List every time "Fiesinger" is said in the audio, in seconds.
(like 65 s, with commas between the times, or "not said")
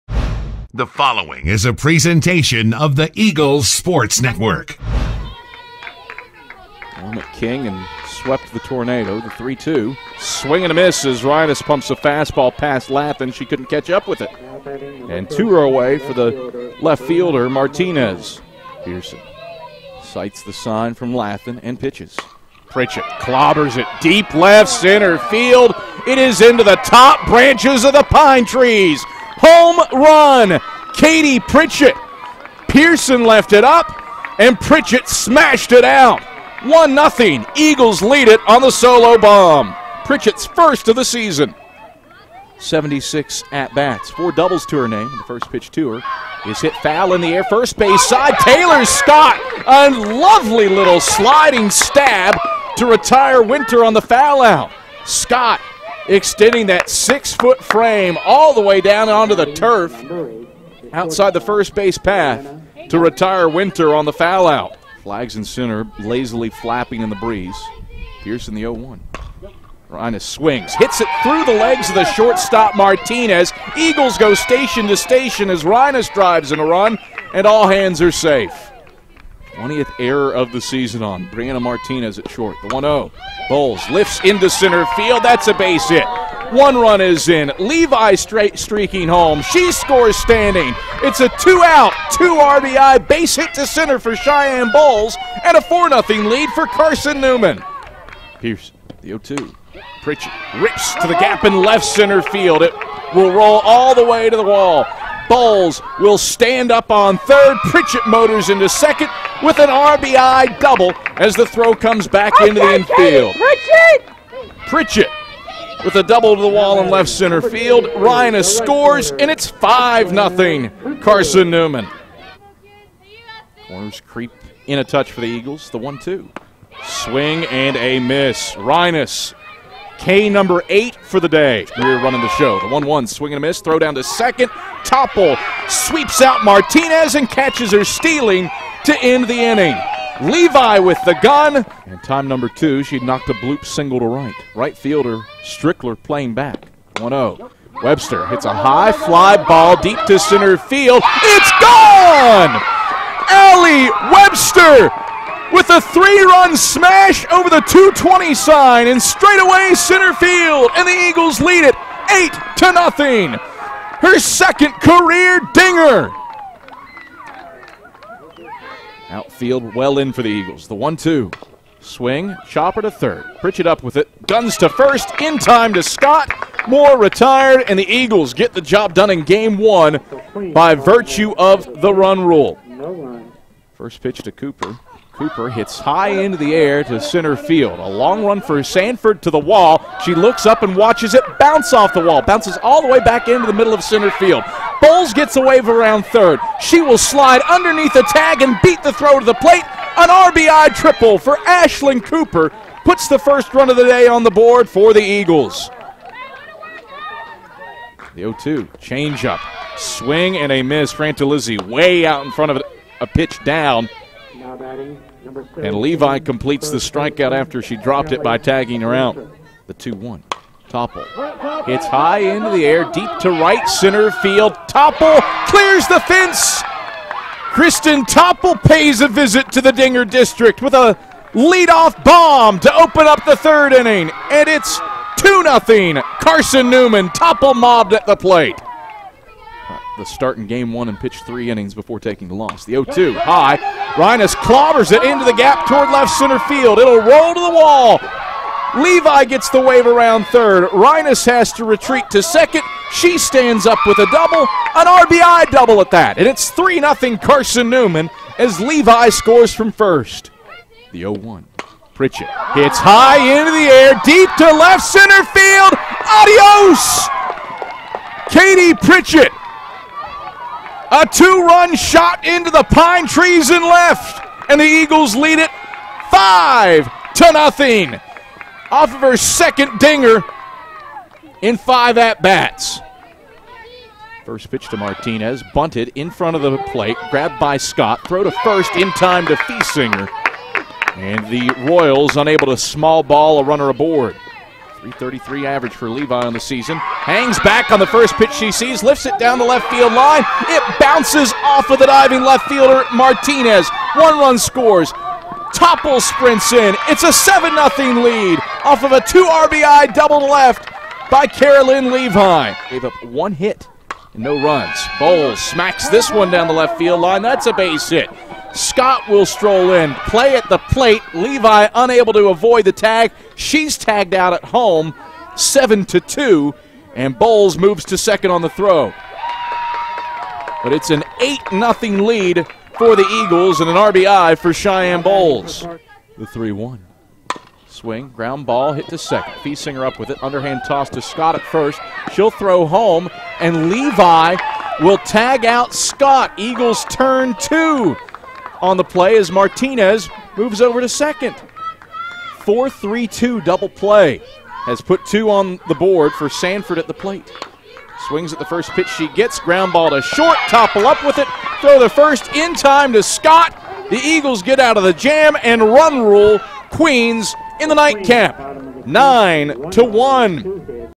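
289 s, 339 s.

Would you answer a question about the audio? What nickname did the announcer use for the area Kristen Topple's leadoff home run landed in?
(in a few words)
Dinger District.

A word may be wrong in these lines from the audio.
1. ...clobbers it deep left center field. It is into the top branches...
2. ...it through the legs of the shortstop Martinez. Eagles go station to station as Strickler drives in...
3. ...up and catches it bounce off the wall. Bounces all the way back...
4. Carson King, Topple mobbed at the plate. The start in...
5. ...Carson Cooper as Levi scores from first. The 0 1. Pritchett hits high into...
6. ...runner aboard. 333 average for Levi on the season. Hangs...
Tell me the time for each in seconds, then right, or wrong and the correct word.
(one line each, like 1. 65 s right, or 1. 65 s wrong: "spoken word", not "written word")
1. 23 s right
2. 71 s wrong: "Reines", not "Strickler"
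3. 190 s wrong: "watches", not "catches"
4. 236 s wrong: "Newman", not "King"
5. 257 s wrong: "Newman", not "Cooper"
6. 293 s right.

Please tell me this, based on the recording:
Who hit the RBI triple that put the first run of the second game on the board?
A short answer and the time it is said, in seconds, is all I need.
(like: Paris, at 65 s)
Ashlyn Cooper, at 201 s.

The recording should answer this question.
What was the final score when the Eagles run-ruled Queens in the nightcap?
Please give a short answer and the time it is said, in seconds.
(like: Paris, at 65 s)
9 to 1, at 368 s.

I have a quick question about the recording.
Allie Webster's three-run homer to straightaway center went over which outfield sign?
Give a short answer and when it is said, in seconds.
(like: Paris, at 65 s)
220, at 157 s.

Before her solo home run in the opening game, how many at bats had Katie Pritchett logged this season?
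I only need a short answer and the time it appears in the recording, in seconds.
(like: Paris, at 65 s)
76, at 42 s.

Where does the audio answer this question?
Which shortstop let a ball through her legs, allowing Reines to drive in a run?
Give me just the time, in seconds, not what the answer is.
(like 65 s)
81 s.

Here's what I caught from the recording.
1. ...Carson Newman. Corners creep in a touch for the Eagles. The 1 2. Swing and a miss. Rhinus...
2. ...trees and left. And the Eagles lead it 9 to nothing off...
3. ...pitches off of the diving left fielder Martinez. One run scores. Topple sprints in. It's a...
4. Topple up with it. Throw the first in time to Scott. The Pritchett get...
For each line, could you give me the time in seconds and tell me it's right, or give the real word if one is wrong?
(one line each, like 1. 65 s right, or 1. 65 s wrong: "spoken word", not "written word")
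1. 121 s right
2. 273 s wrong: "5", not "9"
3. 300 s wrong: "bounces", not "pitches"
4. 360 s wrong: "Eagles", not "Pritchett".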